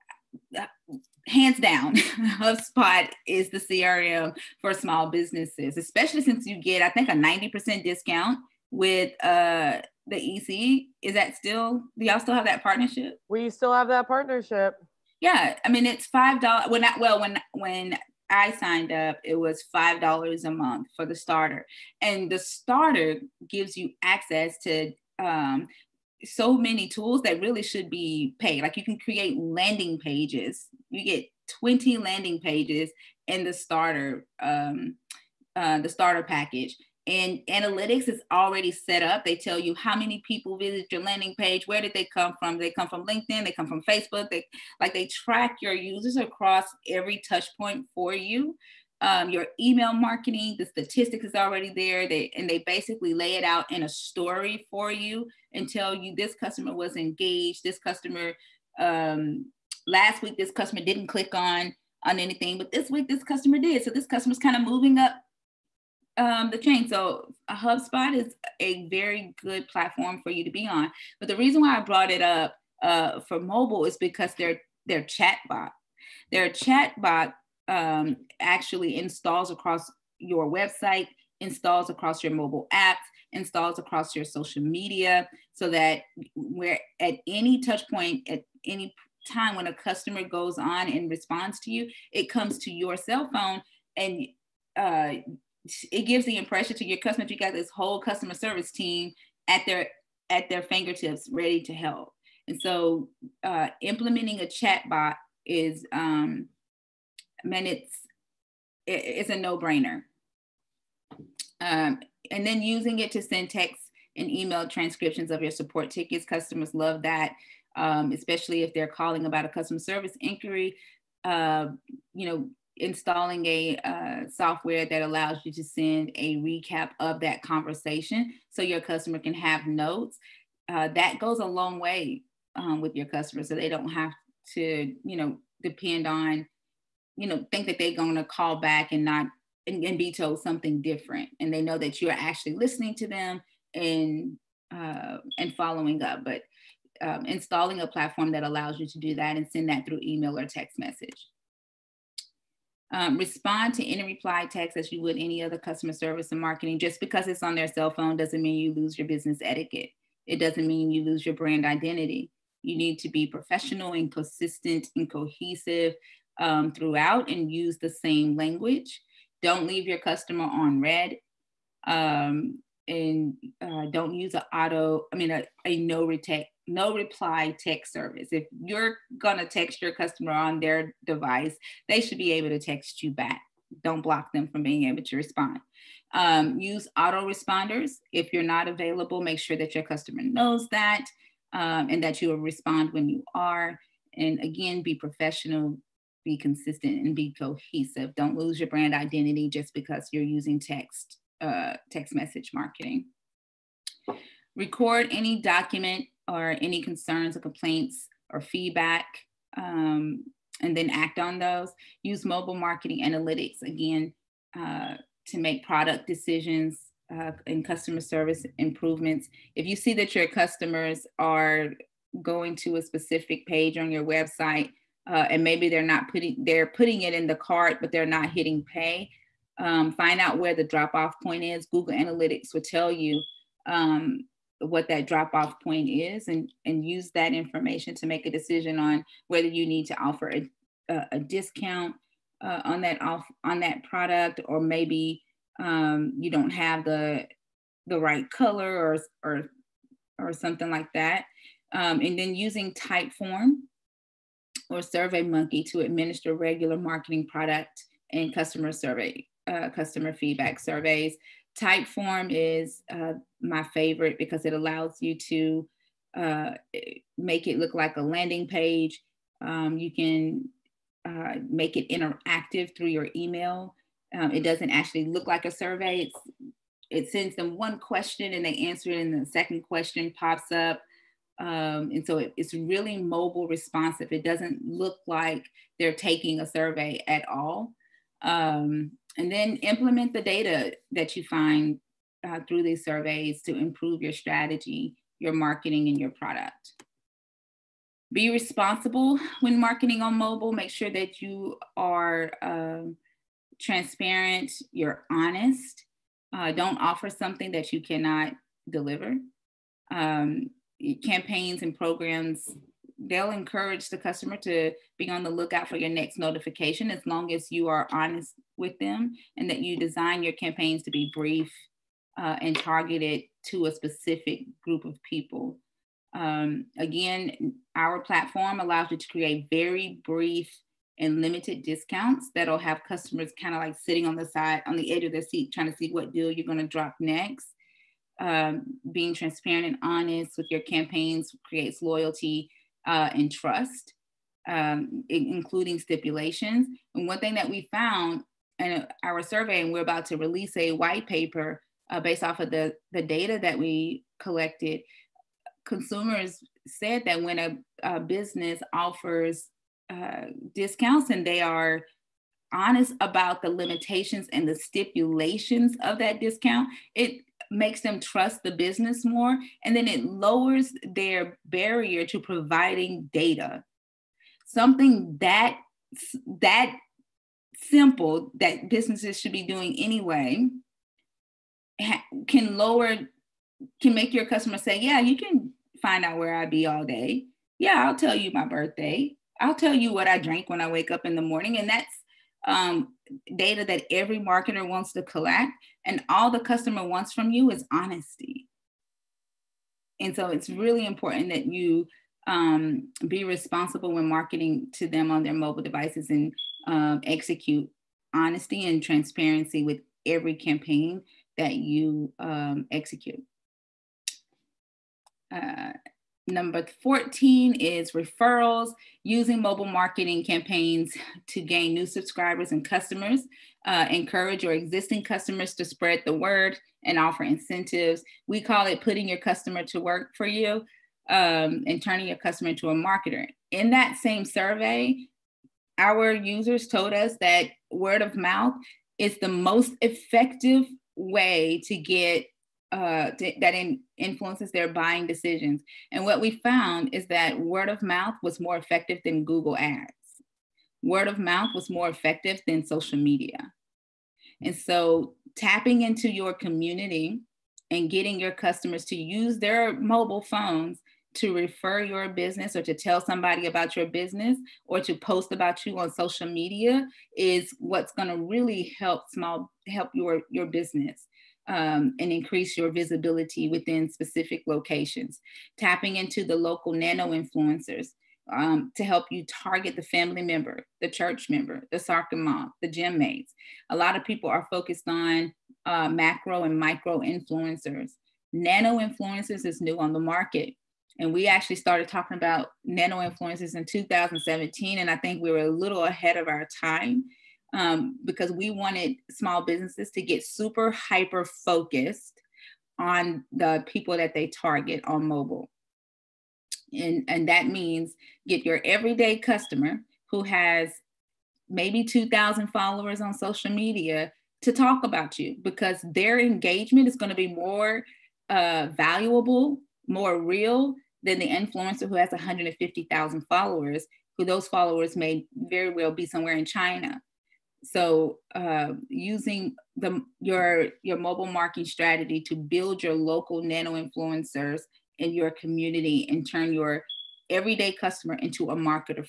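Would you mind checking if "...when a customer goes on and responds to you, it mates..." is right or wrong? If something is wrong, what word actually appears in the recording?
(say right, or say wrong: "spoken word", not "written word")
wrong: "comes", not "mates".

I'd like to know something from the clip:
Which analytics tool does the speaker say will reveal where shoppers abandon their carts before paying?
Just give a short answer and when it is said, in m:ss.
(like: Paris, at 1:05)
Google Analytics, at 3:51.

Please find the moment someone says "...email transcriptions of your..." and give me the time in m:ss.
1:54.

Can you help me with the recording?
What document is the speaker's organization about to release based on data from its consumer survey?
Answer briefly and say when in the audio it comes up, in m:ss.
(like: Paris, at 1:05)
white paper, at 5:50.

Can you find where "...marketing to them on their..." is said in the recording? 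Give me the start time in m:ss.
6:44.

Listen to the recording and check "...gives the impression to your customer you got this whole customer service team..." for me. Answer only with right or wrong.
right.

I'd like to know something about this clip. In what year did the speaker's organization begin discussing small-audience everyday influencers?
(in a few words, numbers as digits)
2017.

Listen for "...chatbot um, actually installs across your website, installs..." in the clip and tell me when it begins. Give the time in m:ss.
1:16.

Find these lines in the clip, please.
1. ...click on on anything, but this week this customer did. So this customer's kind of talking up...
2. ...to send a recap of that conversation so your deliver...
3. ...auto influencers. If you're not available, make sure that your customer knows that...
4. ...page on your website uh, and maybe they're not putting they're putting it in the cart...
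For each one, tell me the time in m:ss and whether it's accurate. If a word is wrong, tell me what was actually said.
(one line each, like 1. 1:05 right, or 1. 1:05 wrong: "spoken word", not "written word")
1. 1:01 wrong: "moving", not "talking"
2. 2:05 wrong: "customer", not "deliver"
3. 3:06 wrong: "responders", not "influencers"
4. 3:43 right.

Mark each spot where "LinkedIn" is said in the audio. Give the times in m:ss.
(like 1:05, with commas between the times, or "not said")
0:43.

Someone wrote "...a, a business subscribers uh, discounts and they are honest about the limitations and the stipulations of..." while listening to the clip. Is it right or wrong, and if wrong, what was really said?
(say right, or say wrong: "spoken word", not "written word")
wrong: "offers", not "subscribers".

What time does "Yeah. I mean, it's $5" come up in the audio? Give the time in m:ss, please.
0:15.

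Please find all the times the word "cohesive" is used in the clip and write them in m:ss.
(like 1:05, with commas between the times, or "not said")
2:45, 3:17.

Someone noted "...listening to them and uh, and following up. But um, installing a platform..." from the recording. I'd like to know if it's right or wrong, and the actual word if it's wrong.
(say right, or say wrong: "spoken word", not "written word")
right.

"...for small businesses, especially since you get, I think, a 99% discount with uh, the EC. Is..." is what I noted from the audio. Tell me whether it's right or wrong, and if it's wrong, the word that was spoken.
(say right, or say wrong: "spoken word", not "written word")
wrong: "90", not "99".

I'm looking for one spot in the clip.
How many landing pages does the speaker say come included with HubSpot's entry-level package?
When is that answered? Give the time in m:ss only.
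0:31.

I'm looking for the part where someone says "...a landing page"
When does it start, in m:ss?
4:27.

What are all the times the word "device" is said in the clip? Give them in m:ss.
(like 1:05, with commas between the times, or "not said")
3:01, 6:45.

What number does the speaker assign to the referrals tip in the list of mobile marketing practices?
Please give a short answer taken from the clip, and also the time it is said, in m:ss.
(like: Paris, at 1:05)
14, at 6:56.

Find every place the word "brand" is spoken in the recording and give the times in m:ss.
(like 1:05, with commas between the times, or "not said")
2:41, 3:18.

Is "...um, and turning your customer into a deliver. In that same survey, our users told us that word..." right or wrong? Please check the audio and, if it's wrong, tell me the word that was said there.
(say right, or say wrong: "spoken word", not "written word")
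wrong: "marketer", not "deliver".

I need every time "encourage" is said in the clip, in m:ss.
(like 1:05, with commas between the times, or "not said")
5:13, 7:03.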